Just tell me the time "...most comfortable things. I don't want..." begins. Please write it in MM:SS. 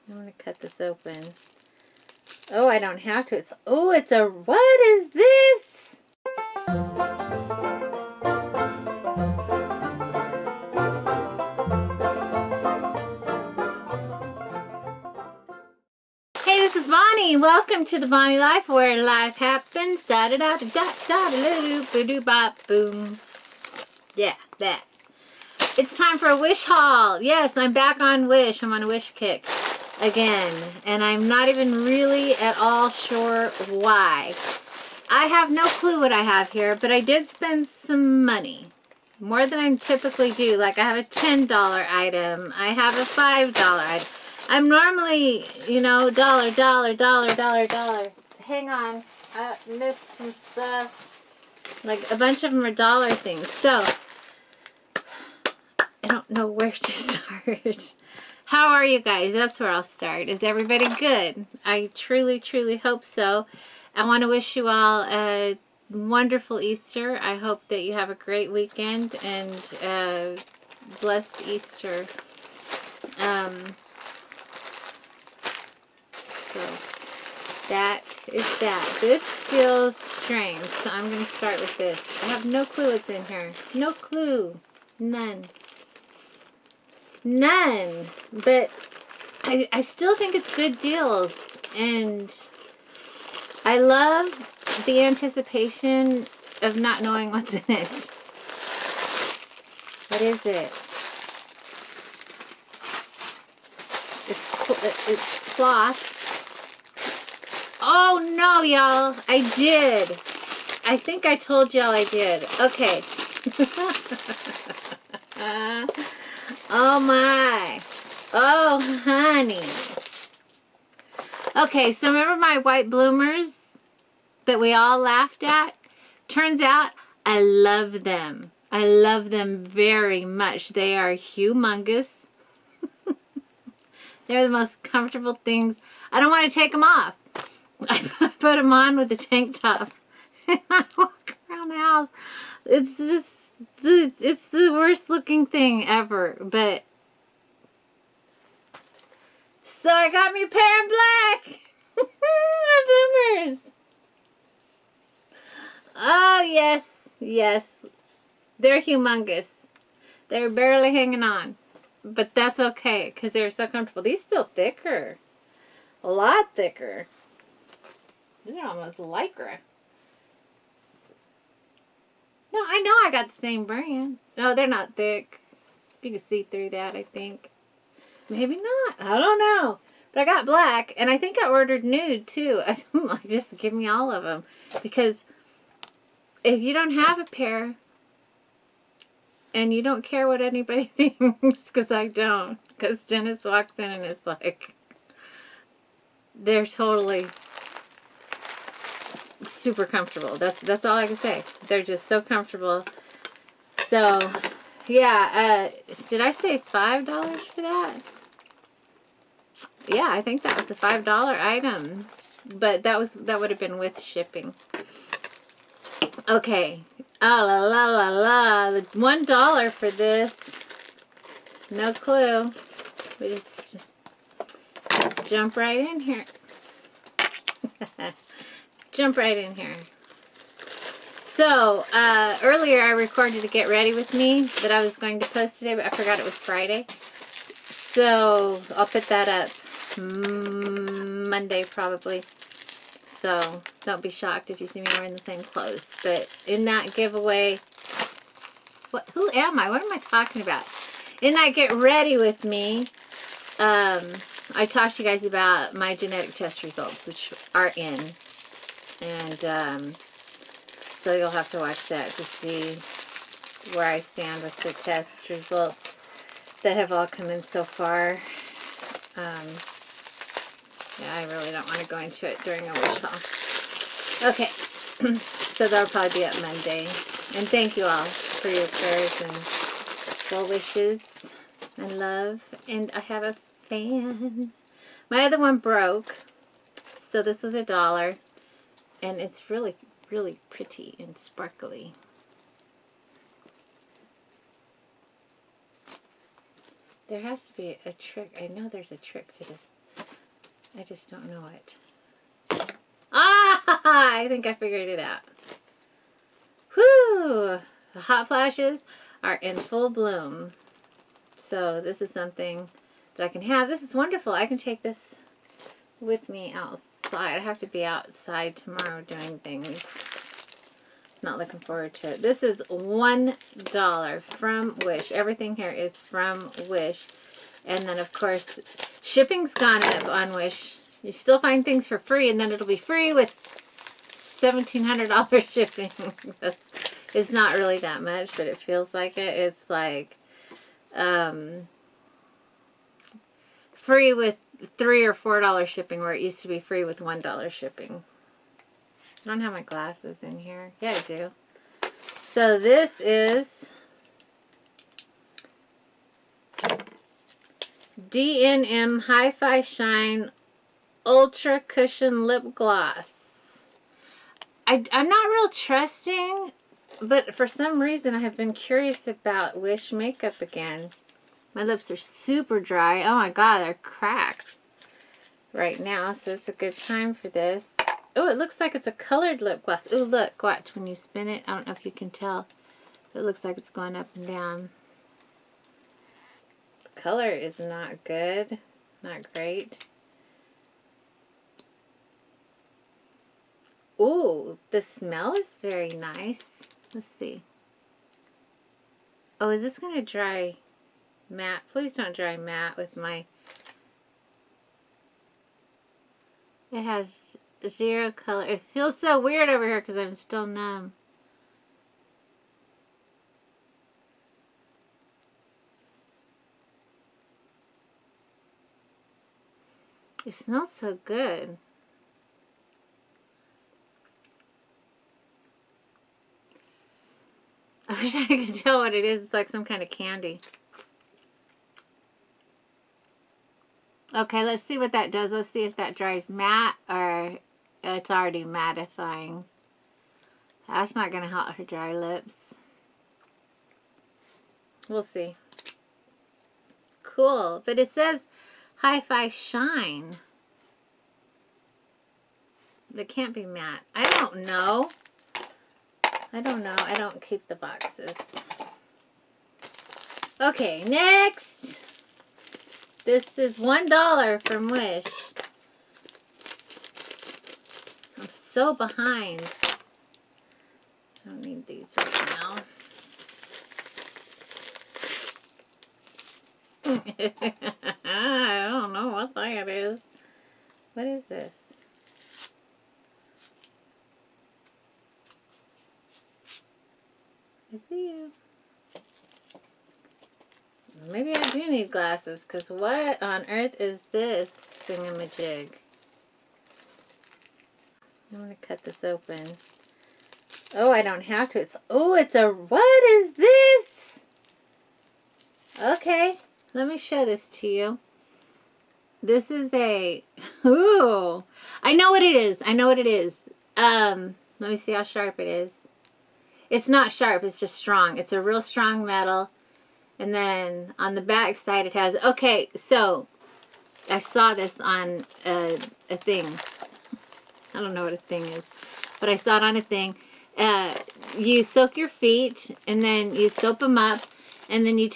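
02:14.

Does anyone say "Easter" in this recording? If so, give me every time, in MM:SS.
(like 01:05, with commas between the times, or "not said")
01:06, 01:11.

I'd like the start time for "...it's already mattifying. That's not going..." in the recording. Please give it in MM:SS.
07:17.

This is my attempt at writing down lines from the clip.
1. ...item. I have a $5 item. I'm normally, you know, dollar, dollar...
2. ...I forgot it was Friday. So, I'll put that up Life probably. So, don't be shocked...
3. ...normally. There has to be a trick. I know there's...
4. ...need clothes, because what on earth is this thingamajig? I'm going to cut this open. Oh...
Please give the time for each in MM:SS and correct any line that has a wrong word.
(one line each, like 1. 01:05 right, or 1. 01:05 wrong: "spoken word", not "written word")
1. 00:41 right
2. 03:55 wrong: "Monday", not "Life"
3. 04:51 wrong: "sparkly", not "normally"
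4. 08:11 wrong: "glasses", not "clothes".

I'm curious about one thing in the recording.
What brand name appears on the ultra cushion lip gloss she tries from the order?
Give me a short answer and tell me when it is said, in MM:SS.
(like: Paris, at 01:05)
DNM, at 05:58.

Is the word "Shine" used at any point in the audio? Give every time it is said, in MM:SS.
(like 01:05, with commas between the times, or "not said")
05:59, 07:29.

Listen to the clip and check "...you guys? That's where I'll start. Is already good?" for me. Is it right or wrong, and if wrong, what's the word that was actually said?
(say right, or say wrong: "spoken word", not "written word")
wrong: "everybody", not "already".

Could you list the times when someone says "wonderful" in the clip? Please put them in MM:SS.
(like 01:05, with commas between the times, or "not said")
01:05, 05:13.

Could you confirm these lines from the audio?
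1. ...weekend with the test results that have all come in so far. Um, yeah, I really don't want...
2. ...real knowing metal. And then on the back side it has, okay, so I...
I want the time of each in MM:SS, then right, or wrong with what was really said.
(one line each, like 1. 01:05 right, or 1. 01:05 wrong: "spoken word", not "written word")
1. 04:23 wrong: "stand", not "weekend"
2. 08:38 wrong: "strong", not "knowing".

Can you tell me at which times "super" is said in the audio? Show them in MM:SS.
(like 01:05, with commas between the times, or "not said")
03:19, 06:11.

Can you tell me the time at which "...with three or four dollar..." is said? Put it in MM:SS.
05:44.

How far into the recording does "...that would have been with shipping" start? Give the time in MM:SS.
03:33.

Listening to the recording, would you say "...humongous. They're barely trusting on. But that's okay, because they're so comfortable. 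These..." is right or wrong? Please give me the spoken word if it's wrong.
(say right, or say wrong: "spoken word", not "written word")
wrong: "hanging", not "trusting".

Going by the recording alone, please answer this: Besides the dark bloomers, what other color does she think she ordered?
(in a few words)
nude.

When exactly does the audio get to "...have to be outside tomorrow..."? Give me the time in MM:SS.
05:17.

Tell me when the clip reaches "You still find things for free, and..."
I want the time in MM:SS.
05:31.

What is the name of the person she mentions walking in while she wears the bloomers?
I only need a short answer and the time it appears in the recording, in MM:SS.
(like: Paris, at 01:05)
Dennis, at 03:13.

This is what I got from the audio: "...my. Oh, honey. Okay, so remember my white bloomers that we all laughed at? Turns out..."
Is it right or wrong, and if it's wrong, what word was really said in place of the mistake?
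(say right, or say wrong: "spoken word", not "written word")
right.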